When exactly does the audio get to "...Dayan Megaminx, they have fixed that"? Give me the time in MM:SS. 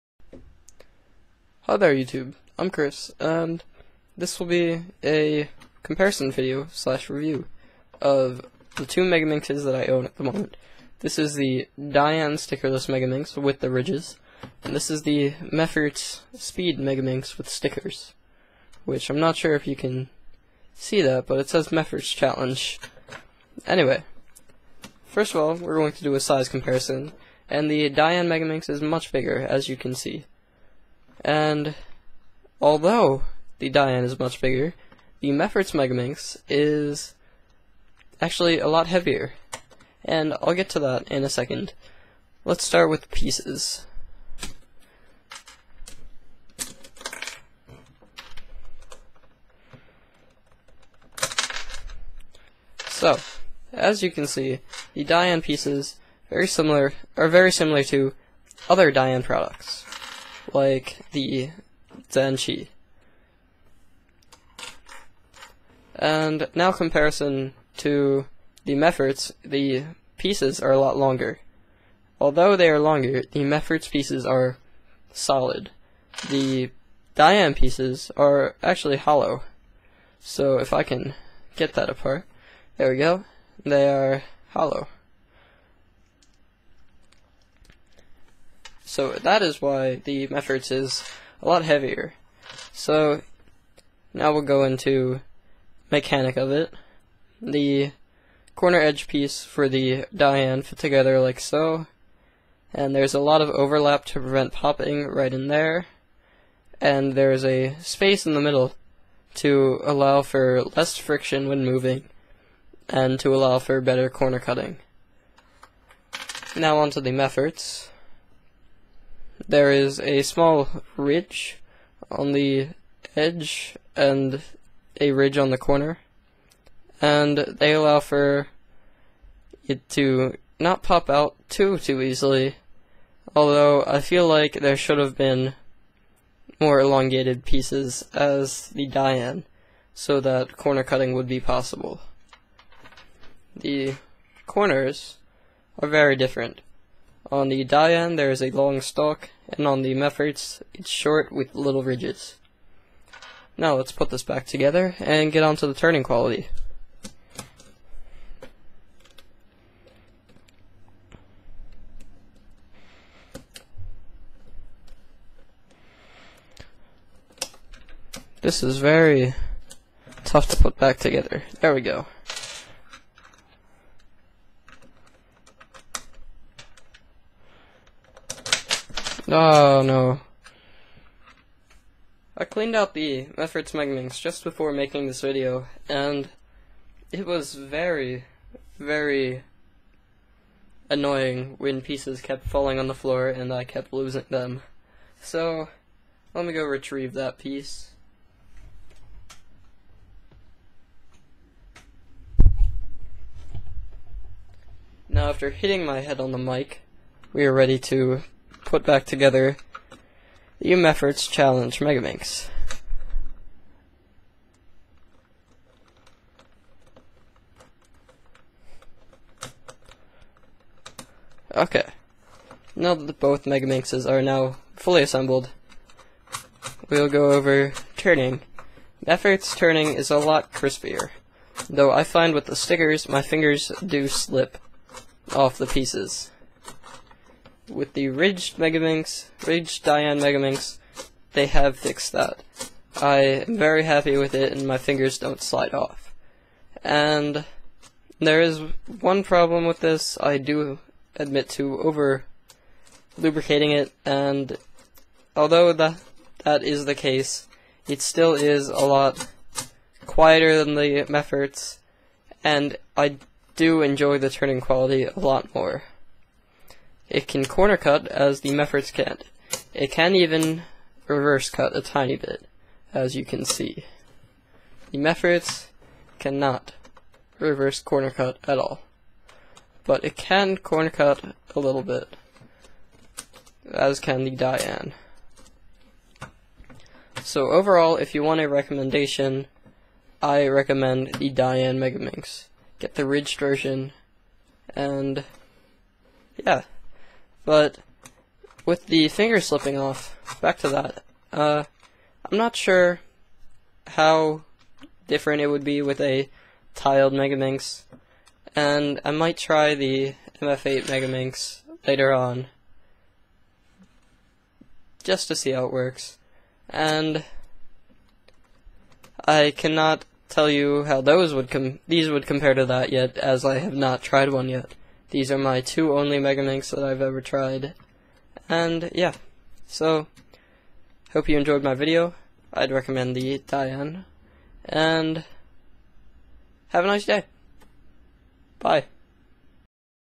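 03:59.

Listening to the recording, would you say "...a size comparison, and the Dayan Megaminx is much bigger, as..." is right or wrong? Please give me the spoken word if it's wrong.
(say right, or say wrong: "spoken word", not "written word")
right.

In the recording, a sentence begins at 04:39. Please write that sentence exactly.
But it can corner cut a little bit, as can the Dayan.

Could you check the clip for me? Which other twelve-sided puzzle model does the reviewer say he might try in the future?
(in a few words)
MF8 Megaminx.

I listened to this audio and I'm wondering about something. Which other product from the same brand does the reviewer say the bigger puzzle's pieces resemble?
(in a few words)
Zhanchi.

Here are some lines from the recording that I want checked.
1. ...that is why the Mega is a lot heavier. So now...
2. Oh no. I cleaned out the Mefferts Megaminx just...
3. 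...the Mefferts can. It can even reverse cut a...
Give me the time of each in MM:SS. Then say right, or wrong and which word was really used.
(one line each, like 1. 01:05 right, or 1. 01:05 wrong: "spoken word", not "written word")
1. 01:29 wrong: "Mefferts", not "Mega"
2. 02:59 right
3. 04:28 right.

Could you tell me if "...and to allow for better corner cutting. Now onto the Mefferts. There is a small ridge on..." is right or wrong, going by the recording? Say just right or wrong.
right.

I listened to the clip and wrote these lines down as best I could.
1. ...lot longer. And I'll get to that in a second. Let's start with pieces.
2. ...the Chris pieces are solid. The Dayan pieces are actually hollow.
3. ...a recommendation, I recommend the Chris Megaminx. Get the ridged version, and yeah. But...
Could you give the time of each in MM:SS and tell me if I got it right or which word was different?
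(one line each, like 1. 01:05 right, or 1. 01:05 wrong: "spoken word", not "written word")
1. 00:38 wrong: "heavier", not "longer"
2. 01:13 wrong: "Mefferts", not "Chris"
3. 04:48 wrong: "Dayan", not "Chris".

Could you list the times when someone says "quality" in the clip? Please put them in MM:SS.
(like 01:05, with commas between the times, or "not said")
02:36, 04:24.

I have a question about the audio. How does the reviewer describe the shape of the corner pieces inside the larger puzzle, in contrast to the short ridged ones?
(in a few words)
long stalk.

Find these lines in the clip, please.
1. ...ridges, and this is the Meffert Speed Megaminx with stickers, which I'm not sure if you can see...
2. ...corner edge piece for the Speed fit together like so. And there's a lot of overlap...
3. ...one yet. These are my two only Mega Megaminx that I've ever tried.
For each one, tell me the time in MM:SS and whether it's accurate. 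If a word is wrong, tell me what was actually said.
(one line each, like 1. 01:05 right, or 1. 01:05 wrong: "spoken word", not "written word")
1. 00:13 right
2. 01:38 wrong: "Dayan", not "Speed"
3. 05:24 right.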